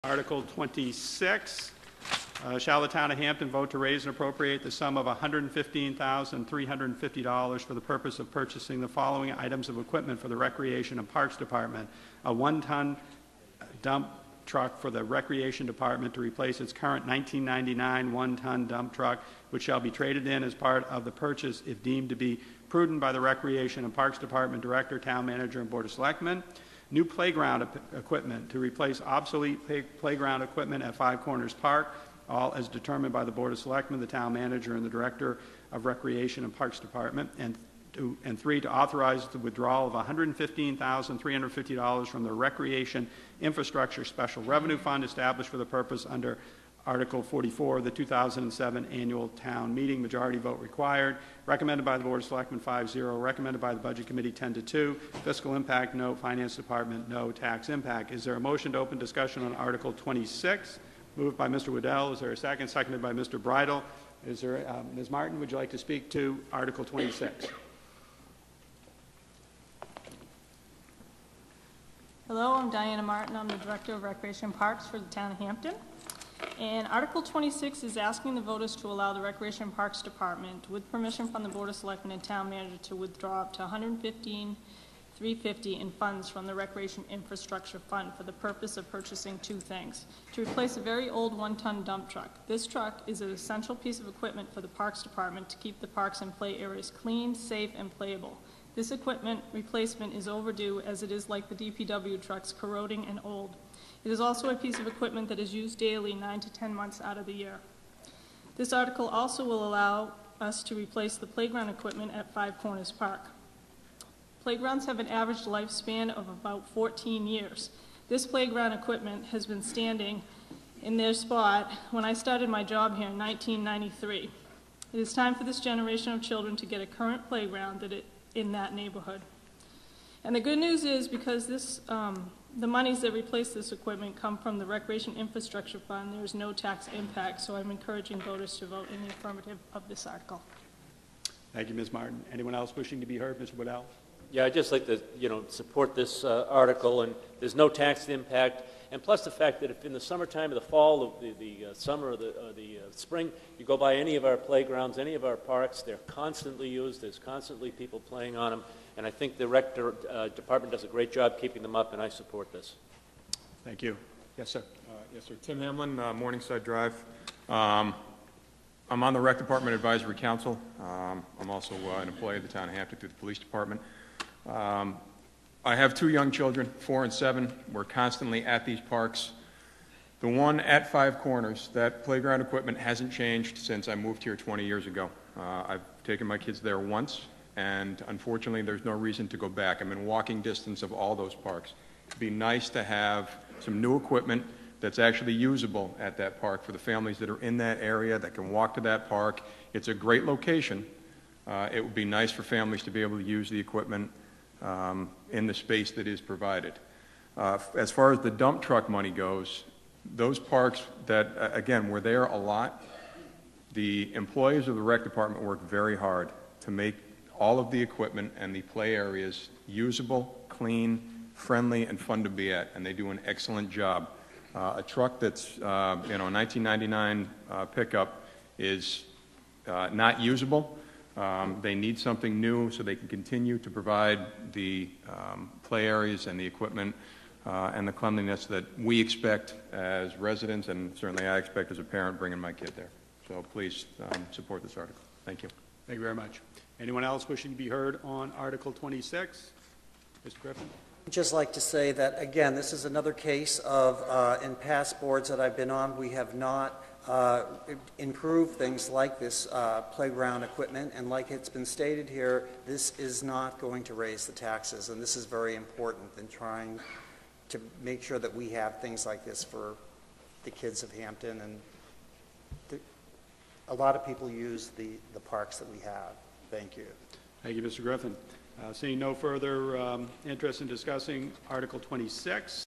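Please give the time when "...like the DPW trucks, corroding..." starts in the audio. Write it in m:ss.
1:41.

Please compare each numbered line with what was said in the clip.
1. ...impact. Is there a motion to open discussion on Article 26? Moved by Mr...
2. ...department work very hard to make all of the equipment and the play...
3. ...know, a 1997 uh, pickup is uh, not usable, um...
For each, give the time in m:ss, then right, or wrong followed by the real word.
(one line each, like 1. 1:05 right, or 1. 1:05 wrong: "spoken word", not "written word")
1. 0:57 right
2. 3:35 right
3. 3:46 wrong: "1999", not "1997".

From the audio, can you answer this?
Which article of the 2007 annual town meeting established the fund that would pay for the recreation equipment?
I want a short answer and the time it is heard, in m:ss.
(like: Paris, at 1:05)
Article 44, at 0:46.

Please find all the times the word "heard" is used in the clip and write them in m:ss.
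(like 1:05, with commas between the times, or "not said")
2:23, 4:07.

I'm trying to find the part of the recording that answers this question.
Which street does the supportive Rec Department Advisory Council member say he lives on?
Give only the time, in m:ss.
2:46.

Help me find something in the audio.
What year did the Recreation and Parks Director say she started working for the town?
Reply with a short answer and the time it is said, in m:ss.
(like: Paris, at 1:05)
1993, at 2:03.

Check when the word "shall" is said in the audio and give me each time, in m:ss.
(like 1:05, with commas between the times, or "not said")
0:02, 0:19.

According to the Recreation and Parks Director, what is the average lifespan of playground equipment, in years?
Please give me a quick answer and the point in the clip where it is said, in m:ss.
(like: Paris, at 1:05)
14, at 1:56.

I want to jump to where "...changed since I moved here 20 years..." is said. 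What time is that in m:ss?
3:03.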